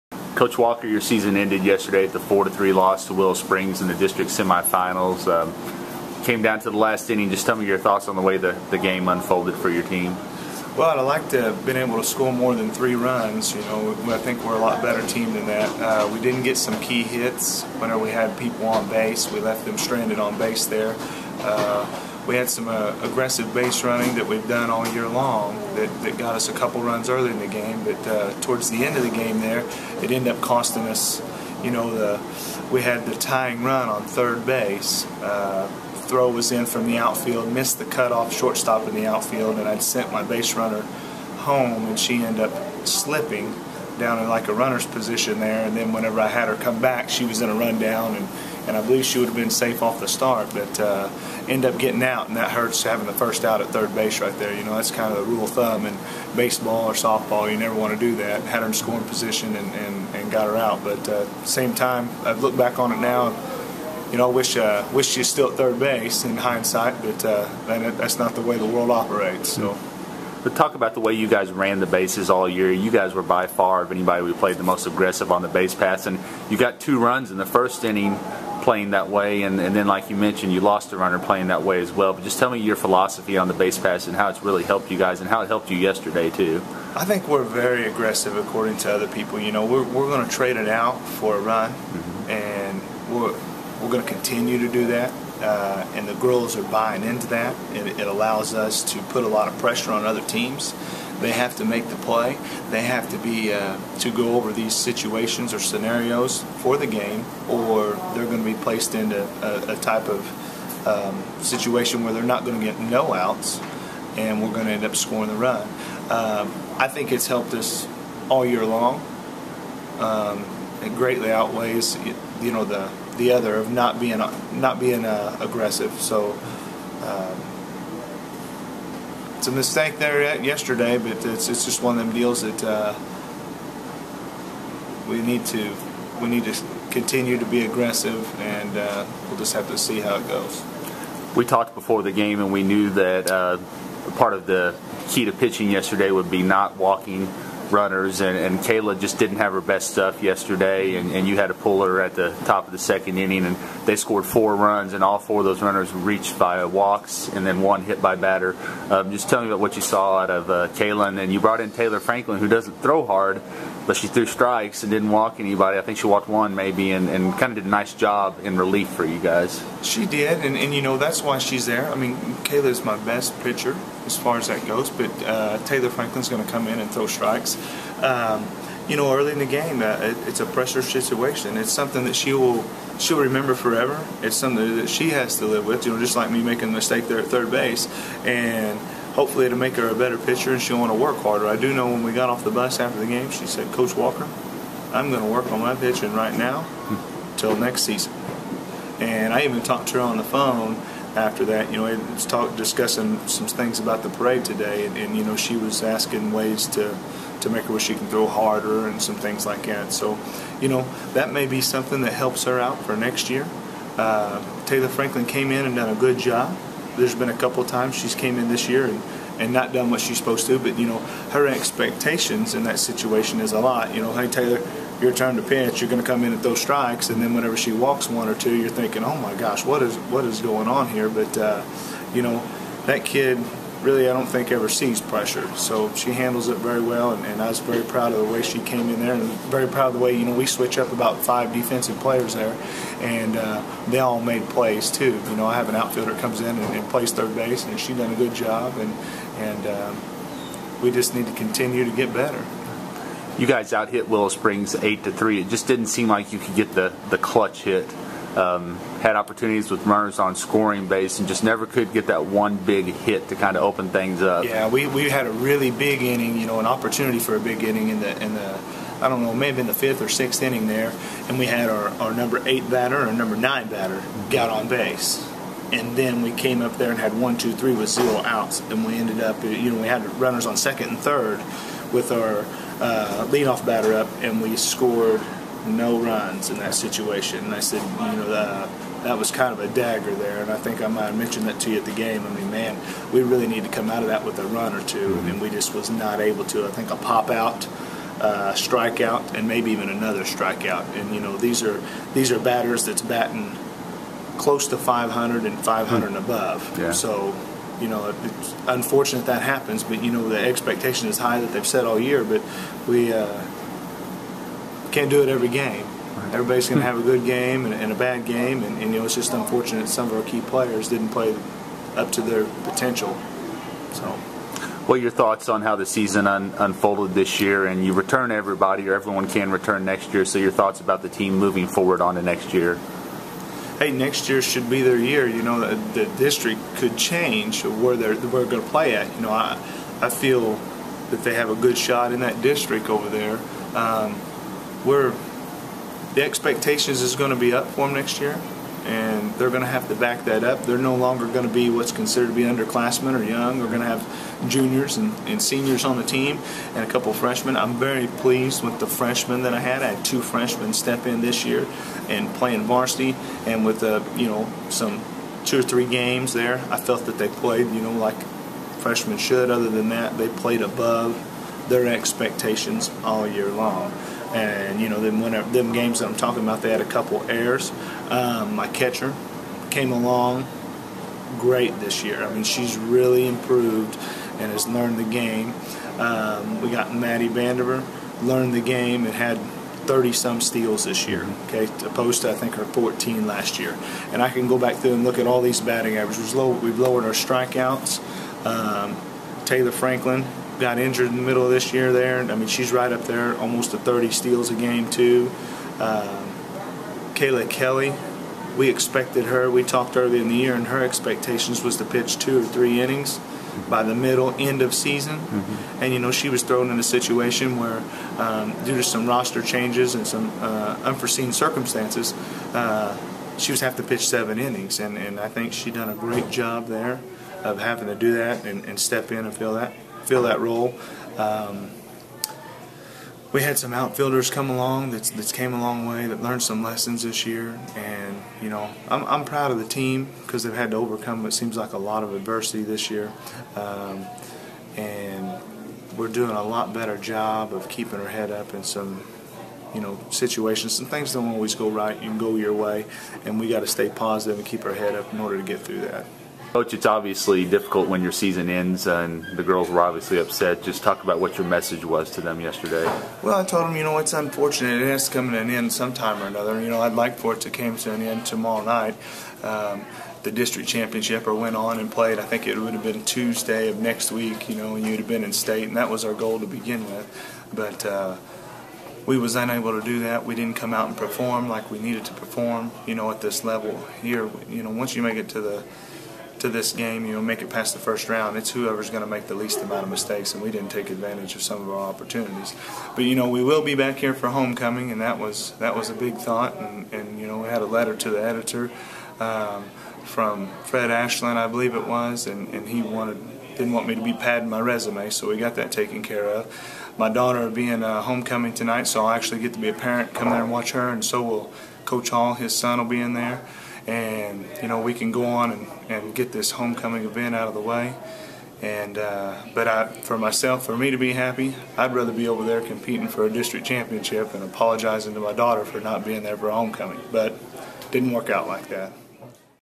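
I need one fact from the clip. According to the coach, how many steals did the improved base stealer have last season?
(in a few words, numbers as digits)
14.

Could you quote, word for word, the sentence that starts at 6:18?
Um, my catcher came along great this year.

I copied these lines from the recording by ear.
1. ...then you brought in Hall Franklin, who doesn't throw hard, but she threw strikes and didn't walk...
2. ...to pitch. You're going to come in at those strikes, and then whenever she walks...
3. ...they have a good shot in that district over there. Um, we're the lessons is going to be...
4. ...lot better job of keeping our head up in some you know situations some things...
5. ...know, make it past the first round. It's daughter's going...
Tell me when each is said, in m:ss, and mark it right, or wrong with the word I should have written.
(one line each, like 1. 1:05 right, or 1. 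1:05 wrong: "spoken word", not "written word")
1. 2:41 wrong: "Taylor", not "Hall"
2. 3:45 right
3. 5:41 wrong: "expectations", not "lessons"
4. 7:26 right
5. 8:07 wrong: "whoever", not "daughter".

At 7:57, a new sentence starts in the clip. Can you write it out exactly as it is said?
But uh, we was unable to do that.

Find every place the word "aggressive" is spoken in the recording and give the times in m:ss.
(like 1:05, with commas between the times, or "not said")
0:23, 1:14, 1:27, 2:05, 2:17.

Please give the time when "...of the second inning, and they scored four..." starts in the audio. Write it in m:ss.
2:32.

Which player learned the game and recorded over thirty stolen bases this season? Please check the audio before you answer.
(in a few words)
Maddie Vandiver.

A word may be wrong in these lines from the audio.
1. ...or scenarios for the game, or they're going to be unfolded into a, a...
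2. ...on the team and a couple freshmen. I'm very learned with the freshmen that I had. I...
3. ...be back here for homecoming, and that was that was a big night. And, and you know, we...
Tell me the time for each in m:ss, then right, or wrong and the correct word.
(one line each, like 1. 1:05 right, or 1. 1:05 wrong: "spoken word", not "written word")
1. 1:45 wrong: "placed", not "unfolded"
2. 5:55 wrong: "pleased", not "learned"
3. 8:13 wrong: "thought", not "night".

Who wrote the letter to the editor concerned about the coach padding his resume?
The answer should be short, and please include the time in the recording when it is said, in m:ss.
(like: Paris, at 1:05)
Fred Ashland, at 8:20.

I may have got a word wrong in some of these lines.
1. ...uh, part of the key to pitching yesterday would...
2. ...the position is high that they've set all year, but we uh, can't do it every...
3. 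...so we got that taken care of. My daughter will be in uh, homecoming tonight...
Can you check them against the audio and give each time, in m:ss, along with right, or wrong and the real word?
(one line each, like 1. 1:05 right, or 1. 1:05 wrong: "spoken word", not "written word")
1. 2:23 right
2. 5:10 wrong: "expectation", not "position"
3. 8:25 right.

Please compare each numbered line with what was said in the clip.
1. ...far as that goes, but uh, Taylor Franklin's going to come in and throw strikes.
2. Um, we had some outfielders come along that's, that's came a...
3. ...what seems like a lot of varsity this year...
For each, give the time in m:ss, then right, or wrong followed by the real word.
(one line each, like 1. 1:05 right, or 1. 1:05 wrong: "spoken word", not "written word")
1. 2:54 right
2. 7:11 right
3. 7:21 wrong: "adversity", not "varsity".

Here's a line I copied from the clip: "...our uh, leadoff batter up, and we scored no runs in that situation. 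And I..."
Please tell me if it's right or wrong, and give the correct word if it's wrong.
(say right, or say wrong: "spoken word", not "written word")
right.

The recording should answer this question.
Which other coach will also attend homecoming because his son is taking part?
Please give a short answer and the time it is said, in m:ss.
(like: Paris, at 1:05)
Coach Hall, at 8:31.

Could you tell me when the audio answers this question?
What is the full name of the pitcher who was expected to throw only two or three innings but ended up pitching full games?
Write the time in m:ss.
6:47.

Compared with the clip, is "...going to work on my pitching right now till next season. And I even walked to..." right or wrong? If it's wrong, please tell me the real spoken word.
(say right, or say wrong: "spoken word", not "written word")
wrong: "talked", not "walked".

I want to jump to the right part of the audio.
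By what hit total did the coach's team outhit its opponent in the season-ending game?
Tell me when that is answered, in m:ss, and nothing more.
4:14.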